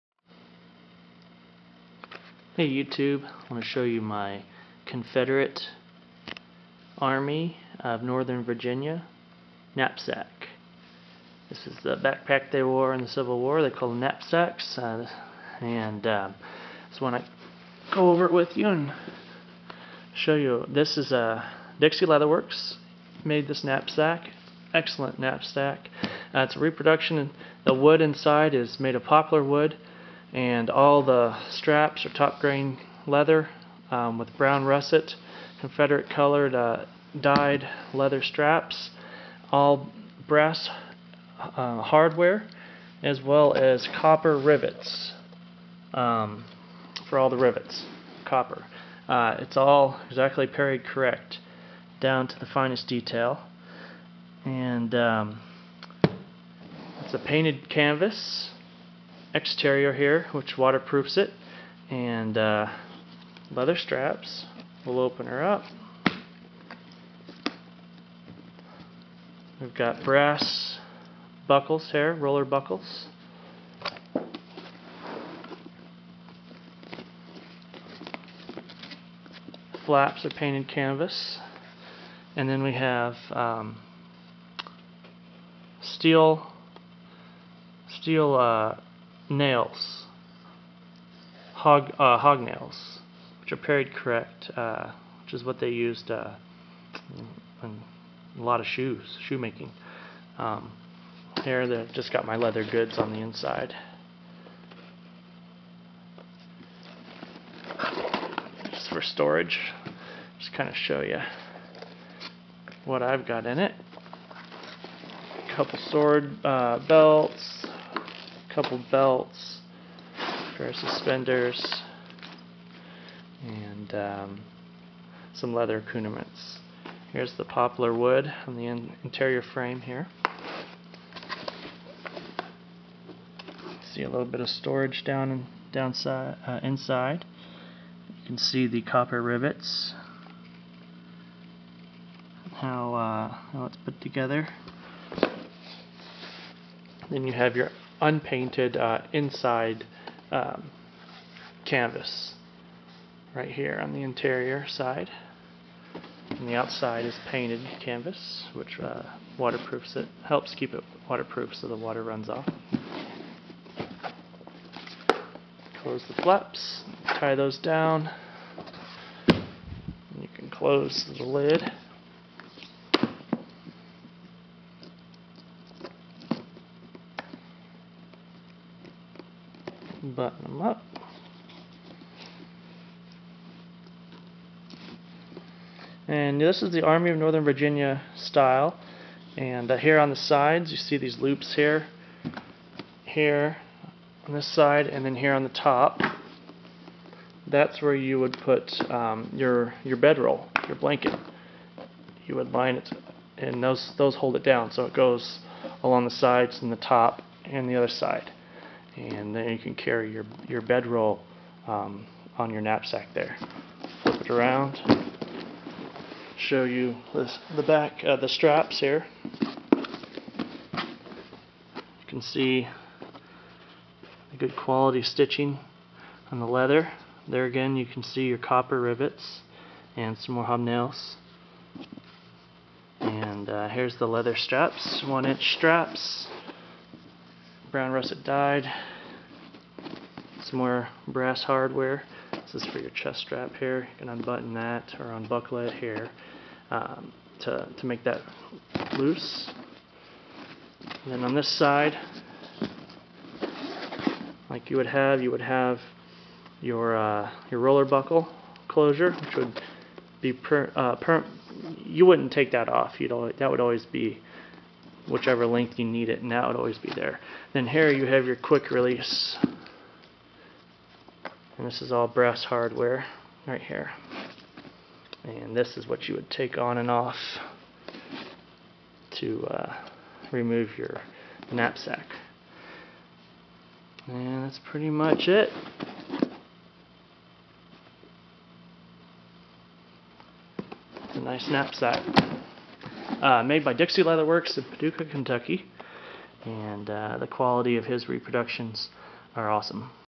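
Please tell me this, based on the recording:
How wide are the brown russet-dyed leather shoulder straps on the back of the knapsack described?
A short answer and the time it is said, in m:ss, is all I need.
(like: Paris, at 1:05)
1 inch, at 3:55.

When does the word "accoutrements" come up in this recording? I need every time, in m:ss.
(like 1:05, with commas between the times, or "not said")
2:05.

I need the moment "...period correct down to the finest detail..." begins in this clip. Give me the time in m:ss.
0:50.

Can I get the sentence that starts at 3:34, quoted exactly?
Flip it around, show you this, the back, uh, the straps here.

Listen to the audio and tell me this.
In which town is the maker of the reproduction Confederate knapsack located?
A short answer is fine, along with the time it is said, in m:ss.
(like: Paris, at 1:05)
Paducah, Kentucky, at 4:54.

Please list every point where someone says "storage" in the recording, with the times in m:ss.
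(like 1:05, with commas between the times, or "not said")
1:49, 2:14.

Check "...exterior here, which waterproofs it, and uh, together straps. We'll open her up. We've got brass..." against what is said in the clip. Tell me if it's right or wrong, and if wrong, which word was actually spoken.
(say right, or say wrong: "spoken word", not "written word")
wrong: "leather", not "together".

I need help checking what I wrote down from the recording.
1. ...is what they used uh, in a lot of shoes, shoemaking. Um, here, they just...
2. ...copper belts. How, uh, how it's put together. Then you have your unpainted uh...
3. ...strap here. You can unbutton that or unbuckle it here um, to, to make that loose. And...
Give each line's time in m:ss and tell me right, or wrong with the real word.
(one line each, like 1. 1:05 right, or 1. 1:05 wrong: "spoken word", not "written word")
1. 1:35 right
2. 2:18 wrong: "rivets", not "belts"
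3. 4:03 right.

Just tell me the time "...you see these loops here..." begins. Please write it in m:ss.
3:10.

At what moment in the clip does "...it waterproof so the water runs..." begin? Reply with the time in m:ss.
2:40.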